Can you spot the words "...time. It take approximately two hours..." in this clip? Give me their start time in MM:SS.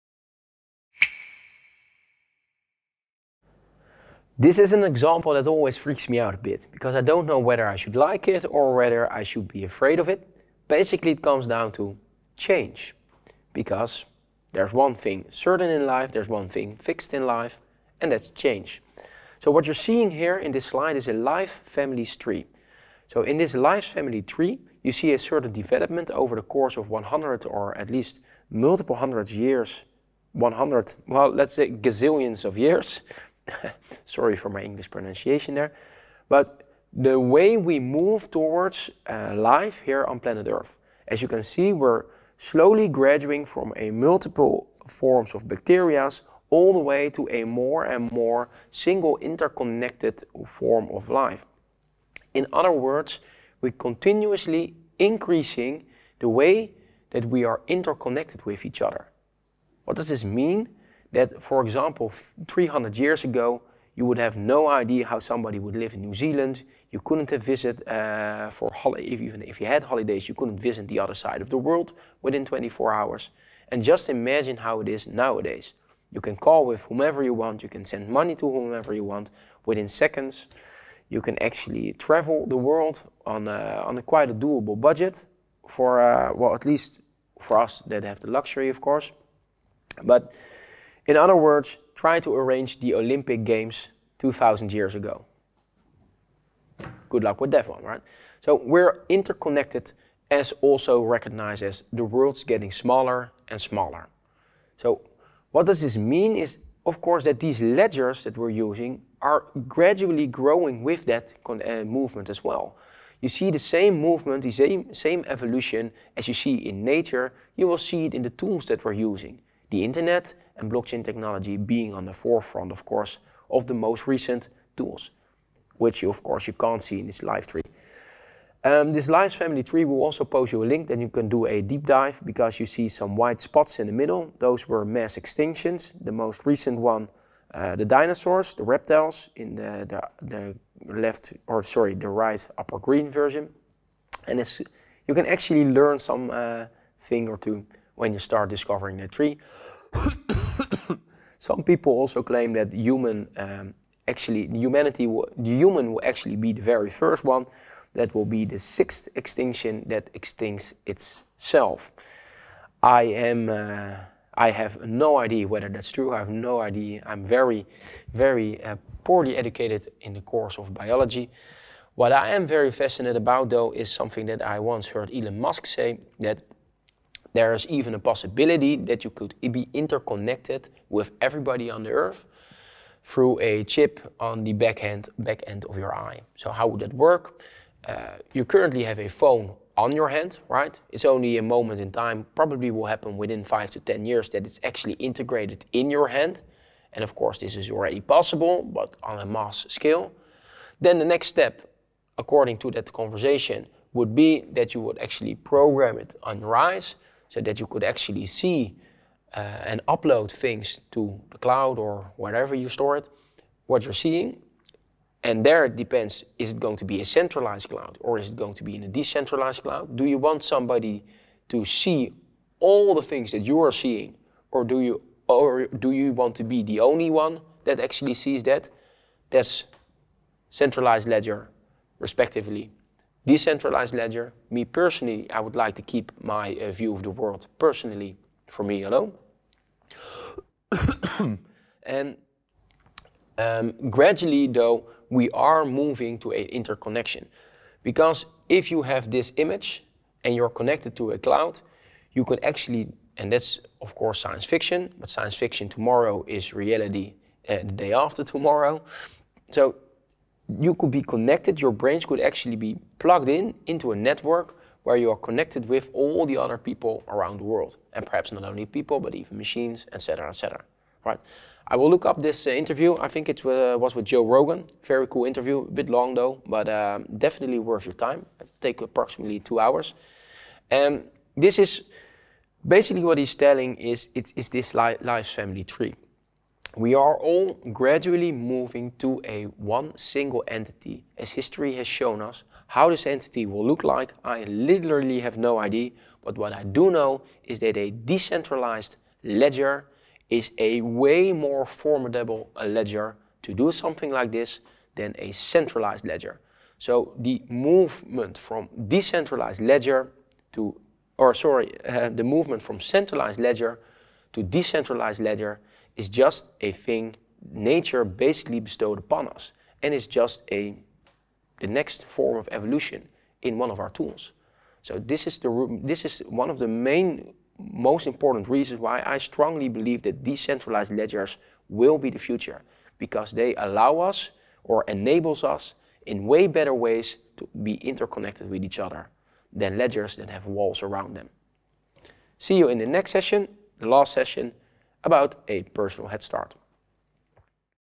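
04:37.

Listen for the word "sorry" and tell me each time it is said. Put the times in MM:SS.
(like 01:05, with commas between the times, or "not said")
00:34, 02:21, 05:11.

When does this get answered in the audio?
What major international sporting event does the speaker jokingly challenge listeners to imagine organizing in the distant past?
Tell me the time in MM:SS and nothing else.
01:32.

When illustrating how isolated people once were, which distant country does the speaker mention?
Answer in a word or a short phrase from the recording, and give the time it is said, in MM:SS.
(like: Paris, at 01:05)
New Zealand, at 01:06.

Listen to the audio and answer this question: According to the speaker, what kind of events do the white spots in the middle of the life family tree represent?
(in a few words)
Mass extinctions.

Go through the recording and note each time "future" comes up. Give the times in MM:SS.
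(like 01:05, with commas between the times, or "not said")
05:32.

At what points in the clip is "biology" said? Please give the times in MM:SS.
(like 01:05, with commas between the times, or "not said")
02:50.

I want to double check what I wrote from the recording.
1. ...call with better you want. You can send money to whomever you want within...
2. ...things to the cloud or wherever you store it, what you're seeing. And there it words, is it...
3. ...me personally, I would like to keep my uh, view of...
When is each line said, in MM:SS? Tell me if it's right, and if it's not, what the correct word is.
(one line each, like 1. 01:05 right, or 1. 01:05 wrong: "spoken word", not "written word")
1. 01:16 wrong: "whomever", not "better"
2. 03:30 wrong: "depends", not "words"
3. 03:54 right.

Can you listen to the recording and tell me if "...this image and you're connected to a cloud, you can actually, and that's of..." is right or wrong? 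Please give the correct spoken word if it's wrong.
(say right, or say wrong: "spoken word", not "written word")
right.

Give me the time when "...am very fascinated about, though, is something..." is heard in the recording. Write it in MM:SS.
02:52.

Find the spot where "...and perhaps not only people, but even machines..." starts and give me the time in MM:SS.
04:27.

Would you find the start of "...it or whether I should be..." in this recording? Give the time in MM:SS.
00:08.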